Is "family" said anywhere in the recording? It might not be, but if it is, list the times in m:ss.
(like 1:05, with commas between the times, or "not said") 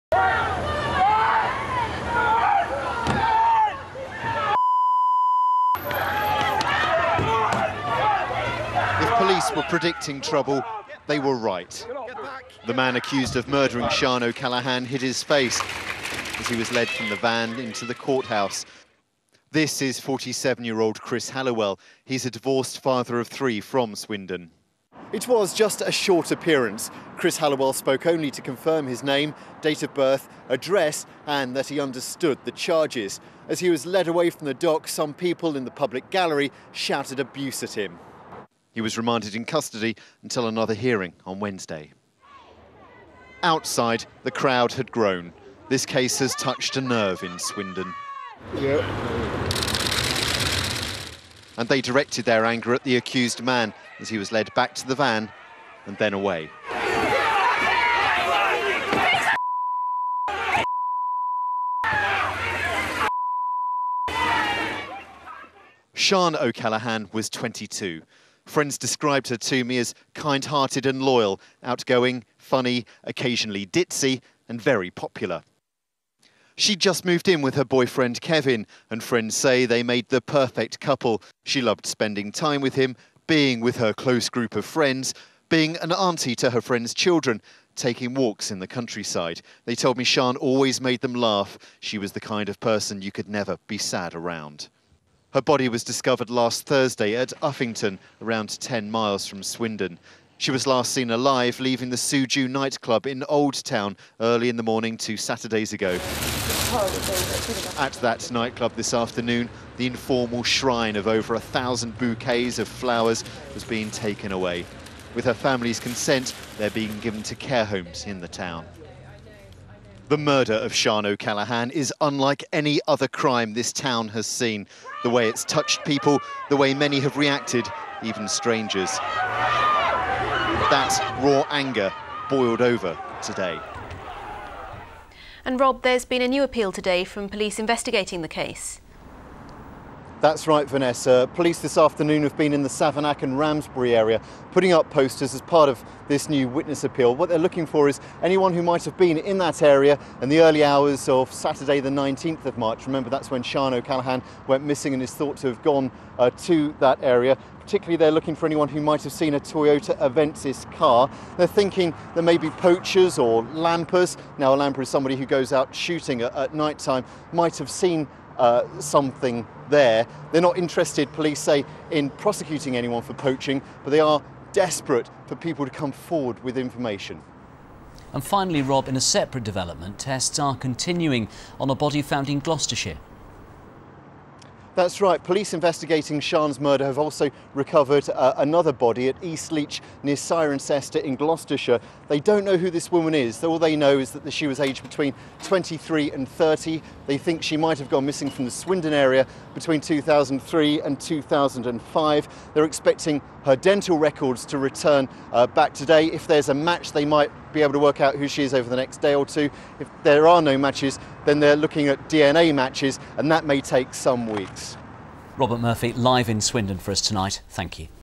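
1:55.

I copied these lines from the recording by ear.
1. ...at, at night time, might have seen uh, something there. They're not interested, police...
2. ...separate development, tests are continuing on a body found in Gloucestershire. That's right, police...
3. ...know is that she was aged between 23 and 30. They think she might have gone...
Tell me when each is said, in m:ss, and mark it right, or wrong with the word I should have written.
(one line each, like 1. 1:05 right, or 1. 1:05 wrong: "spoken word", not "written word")
1. 2:46 right
2. 2:59 right
3. 3:13 right.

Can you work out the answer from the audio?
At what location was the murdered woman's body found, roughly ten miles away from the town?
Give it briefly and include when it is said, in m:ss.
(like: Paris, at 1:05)
Uffington, at 1:37.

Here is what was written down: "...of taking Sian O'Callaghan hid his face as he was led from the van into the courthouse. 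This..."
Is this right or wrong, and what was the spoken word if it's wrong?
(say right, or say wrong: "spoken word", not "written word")
wrong: "murdering", not "taking".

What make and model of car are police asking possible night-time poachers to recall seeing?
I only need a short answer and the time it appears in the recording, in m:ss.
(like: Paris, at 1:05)
Toyota Avensis, at 2:39.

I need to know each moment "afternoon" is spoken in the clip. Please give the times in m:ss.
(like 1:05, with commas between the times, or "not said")
1:48, 2:21.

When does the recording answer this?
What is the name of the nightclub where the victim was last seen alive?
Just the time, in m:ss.
1:41.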